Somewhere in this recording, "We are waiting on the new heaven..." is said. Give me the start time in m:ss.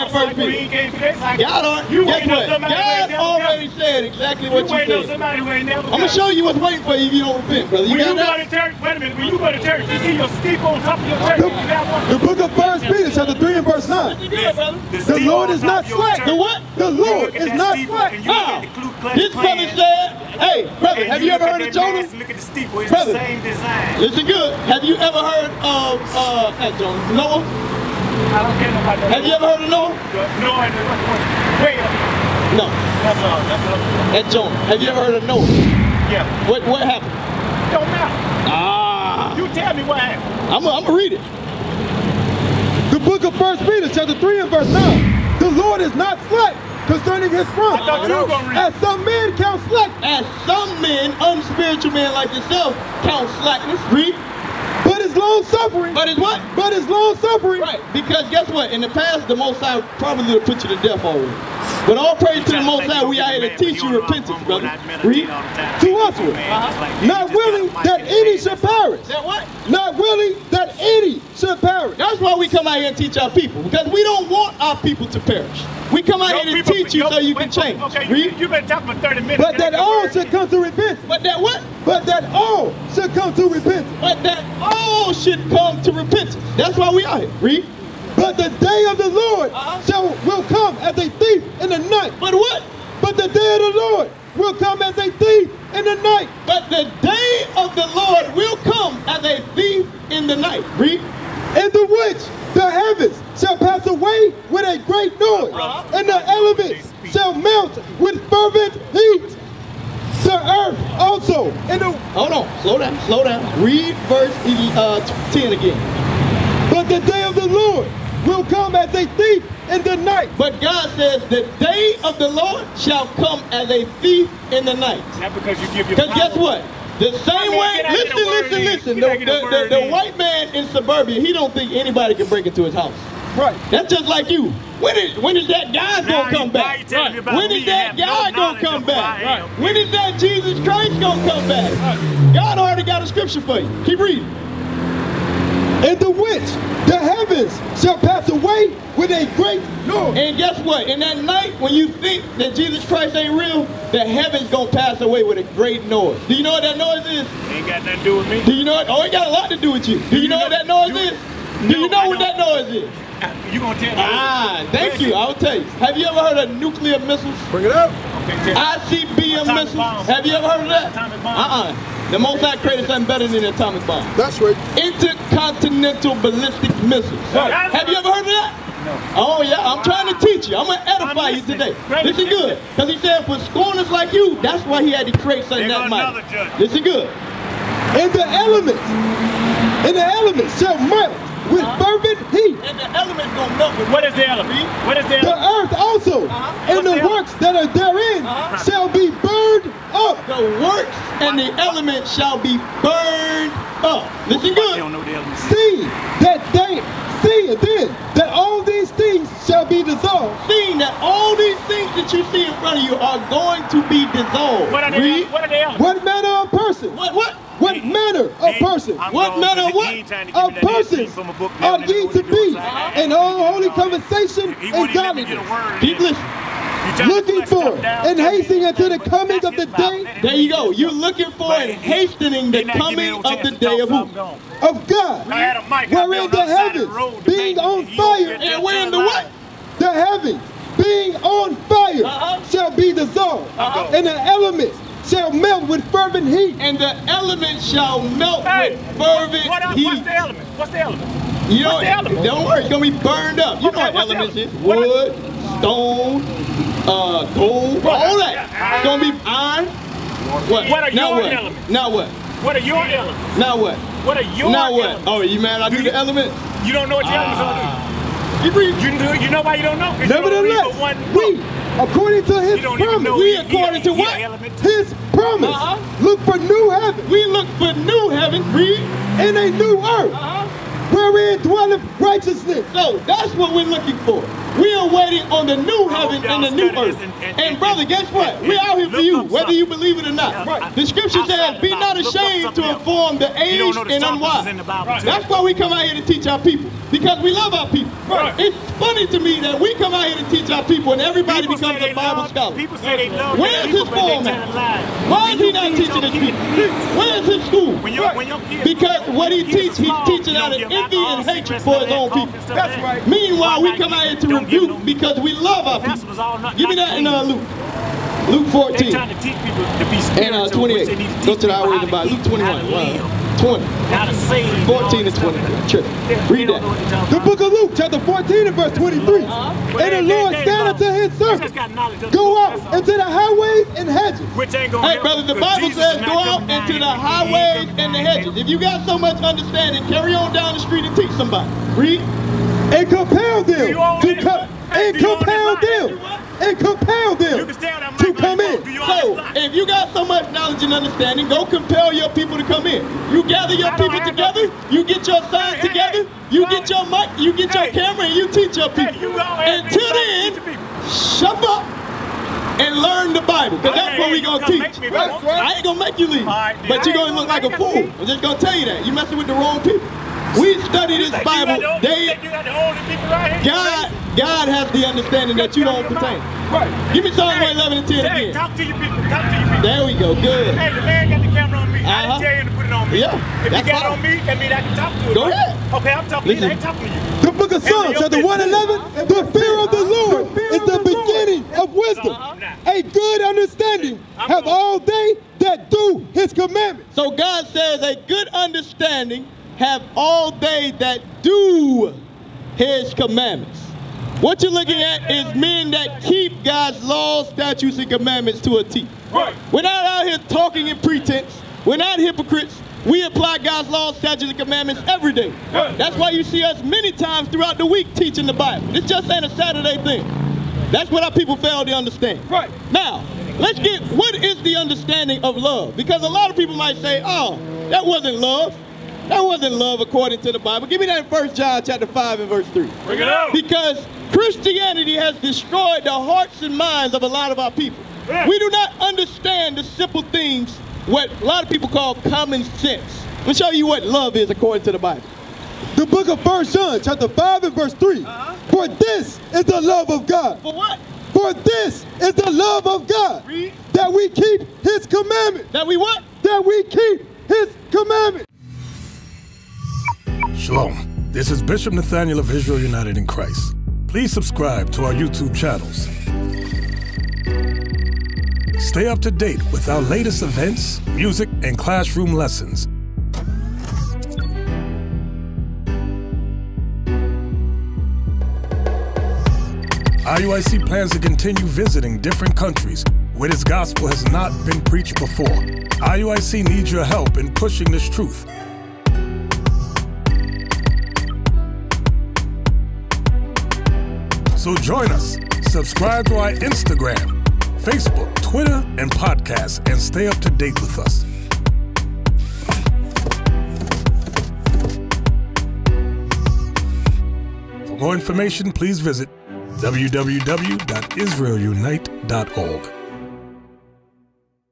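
4:44.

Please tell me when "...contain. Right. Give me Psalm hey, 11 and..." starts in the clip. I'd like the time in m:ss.
6:15.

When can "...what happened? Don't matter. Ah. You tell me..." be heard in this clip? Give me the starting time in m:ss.
0:36.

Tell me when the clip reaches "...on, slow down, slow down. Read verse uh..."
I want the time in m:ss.
1:52.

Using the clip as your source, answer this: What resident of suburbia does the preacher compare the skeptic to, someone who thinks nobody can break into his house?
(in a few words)
white man.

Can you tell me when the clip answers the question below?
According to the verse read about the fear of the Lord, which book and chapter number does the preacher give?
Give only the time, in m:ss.
6:27.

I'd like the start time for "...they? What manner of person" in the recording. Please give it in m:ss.
3:35.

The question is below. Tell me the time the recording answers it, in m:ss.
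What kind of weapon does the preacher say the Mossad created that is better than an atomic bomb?
2:54.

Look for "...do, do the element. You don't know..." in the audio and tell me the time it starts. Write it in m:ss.
4:25.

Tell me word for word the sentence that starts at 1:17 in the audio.
Okay, you, have been talking for 30 minutes.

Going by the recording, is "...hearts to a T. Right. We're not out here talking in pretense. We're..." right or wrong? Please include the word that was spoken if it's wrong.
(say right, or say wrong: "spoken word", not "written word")
wrong: "commandments", not "hearts".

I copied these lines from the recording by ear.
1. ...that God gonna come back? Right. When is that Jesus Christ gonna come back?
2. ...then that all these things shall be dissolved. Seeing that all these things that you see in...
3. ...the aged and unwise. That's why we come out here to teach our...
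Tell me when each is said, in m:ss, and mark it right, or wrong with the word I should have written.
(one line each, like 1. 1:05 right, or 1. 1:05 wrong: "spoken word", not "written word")
1. 2:17 right
2. 3:27 right
3. 4:53 right.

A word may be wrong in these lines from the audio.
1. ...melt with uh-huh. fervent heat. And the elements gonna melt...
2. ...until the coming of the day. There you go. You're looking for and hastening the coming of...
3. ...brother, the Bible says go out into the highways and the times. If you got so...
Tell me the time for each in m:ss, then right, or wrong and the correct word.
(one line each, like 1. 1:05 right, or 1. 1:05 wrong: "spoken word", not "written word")
1. 3:10 right
2. 3:48 right
3. 5:35 wrong: "hedges", not "times".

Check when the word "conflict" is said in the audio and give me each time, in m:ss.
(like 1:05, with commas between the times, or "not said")
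not said.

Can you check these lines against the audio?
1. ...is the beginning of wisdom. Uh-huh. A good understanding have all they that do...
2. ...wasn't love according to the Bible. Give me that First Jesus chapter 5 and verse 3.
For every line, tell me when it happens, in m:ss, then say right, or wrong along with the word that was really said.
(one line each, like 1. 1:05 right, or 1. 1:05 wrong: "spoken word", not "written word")
1. 6:30 right
2. 7:09 wrong: "John", not "Jesus".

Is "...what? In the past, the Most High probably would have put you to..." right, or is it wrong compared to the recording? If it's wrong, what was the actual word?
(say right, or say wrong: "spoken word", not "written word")
right.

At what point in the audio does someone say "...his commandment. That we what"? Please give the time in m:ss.
7:34.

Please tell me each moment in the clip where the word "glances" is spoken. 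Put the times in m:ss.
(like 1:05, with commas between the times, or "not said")
not said.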